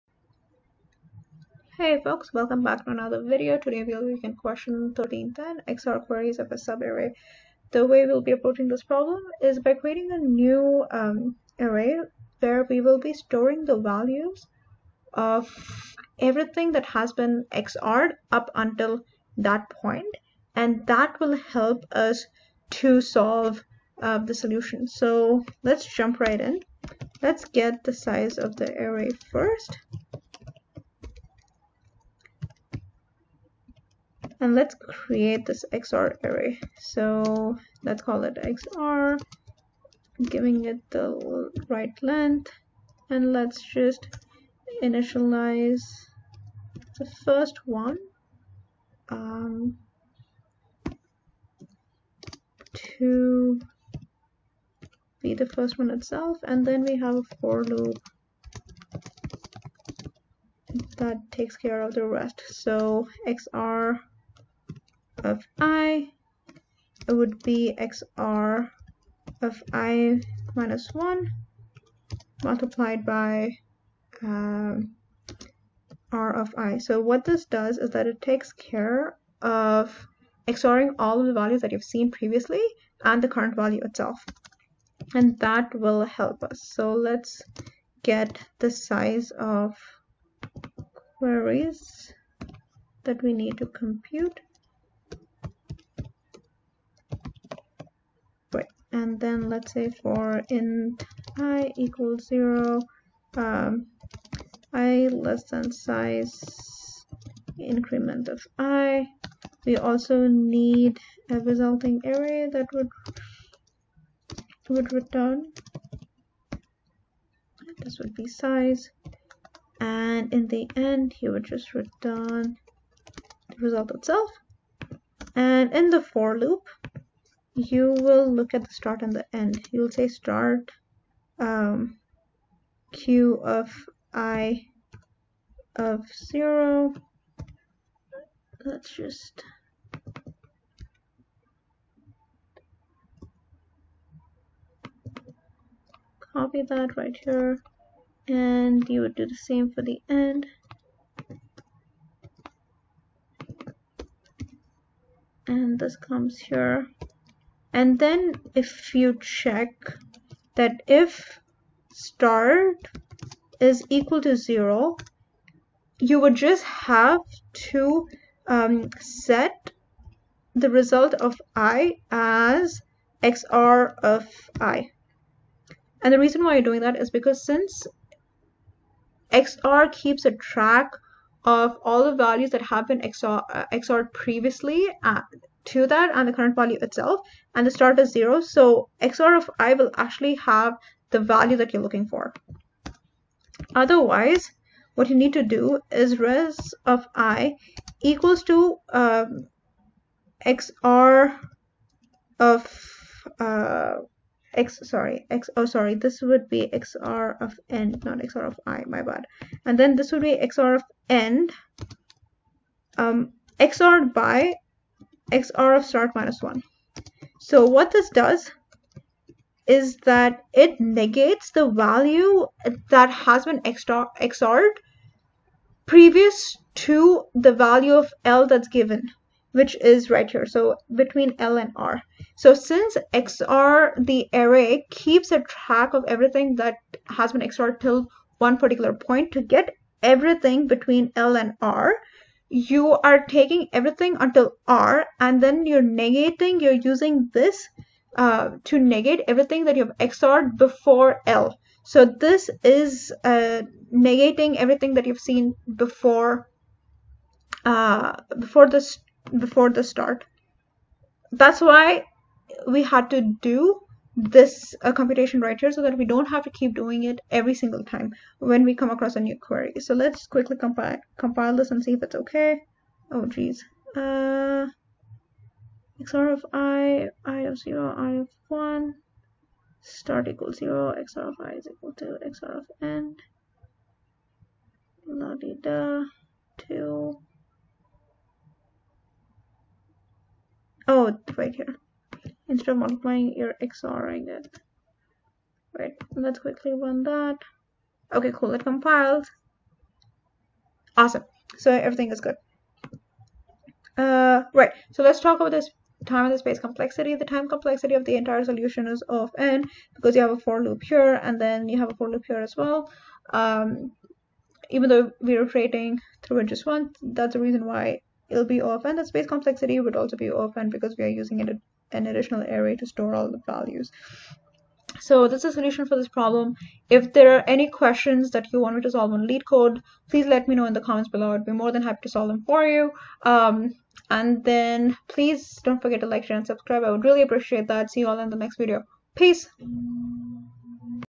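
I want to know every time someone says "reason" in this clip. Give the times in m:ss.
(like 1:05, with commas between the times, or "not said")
2:56, 5:17.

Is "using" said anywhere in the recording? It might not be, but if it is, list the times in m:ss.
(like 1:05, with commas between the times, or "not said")
4:06, 5:21.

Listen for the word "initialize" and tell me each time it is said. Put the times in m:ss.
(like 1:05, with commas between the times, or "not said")
0:44.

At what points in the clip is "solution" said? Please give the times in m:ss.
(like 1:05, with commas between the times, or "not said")
0:24, 5:08, 5:25.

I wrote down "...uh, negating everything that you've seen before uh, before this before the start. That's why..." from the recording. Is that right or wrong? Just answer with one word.
right.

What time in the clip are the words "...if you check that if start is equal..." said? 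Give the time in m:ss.
2:38.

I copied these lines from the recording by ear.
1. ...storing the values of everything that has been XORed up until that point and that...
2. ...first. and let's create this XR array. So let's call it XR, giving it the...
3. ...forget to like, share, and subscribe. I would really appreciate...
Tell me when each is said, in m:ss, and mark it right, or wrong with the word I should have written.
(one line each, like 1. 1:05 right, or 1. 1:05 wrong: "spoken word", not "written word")
1. 0:13 right
2. 0:29 right
3. 5:35 right.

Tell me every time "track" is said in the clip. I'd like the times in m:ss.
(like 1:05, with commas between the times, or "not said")
3:00, 3:55.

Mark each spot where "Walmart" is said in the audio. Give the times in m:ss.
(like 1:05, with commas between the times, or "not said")
not said.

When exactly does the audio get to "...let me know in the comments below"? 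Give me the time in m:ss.
5:30.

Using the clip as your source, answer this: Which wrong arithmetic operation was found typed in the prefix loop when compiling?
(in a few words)
multiplying.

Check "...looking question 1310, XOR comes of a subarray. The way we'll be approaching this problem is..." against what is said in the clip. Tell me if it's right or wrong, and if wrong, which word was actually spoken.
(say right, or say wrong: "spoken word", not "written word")
wrong: "queries", not "comes".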